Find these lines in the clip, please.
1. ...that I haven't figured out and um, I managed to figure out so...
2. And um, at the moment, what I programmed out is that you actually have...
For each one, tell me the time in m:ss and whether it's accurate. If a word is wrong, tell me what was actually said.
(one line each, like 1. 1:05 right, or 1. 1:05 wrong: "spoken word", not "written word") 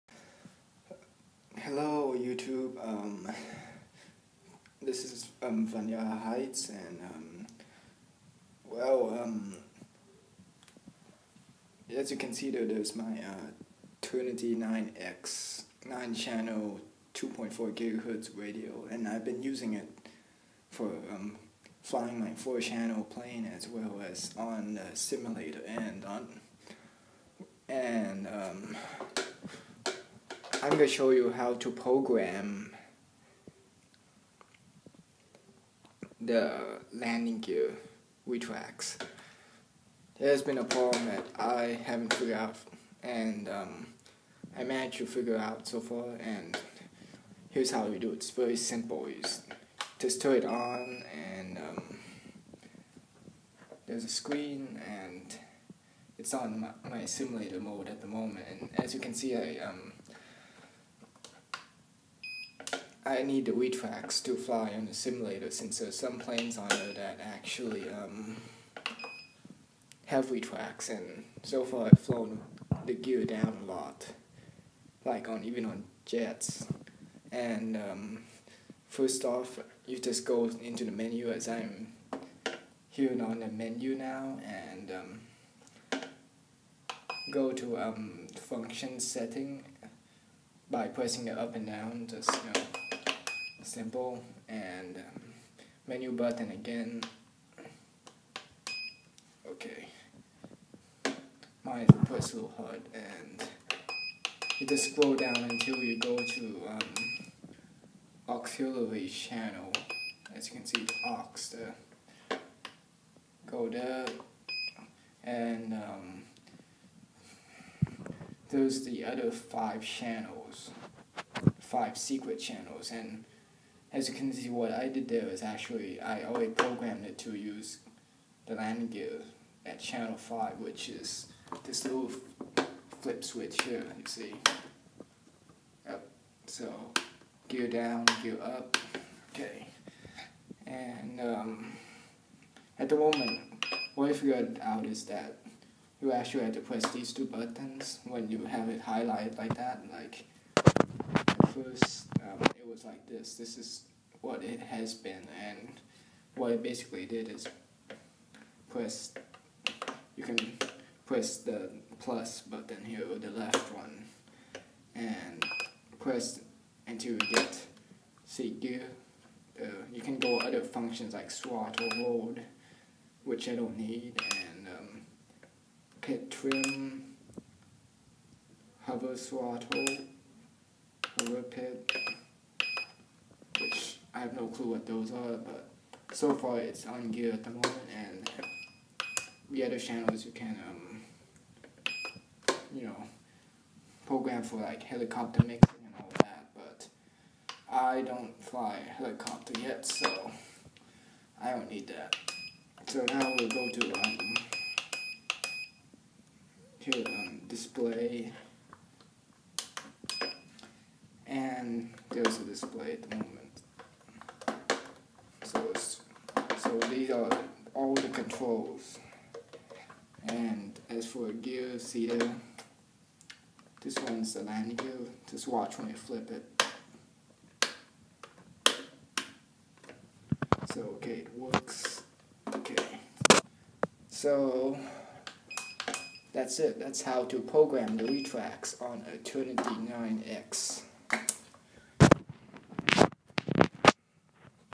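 1. 0:41 right
2. 2:20 wrong: "figured", not "programmed".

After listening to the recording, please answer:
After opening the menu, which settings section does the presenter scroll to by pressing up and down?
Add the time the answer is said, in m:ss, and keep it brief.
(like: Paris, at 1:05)
Function setting, at 1:28.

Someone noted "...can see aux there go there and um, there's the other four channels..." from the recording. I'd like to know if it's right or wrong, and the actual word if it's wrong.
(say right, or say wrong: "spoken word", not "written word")
wrong: "five", not "four".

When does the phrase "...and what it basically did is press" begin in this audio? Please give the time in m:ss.
2:35.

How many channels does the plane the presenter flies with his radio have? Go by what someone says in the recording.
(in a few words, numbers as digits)
4.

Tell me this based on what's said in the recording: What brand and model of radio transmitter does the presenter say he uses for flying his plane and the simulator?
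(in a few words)
Turnigy 9X.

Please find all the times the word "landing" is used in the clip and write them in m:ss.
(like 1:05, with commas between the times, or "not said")
0:36, 2:08, 3:44.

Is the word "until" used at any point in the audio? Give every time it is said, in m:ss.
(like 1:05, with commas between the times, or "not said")
1:45, 2:46.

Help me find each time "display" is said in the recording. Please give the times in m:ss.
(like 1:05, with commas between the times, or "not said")
3:27, 3:32.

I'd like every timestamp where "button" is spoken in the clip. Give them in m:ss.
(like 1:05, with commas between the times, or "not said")
1:36, 2:27, 2:42.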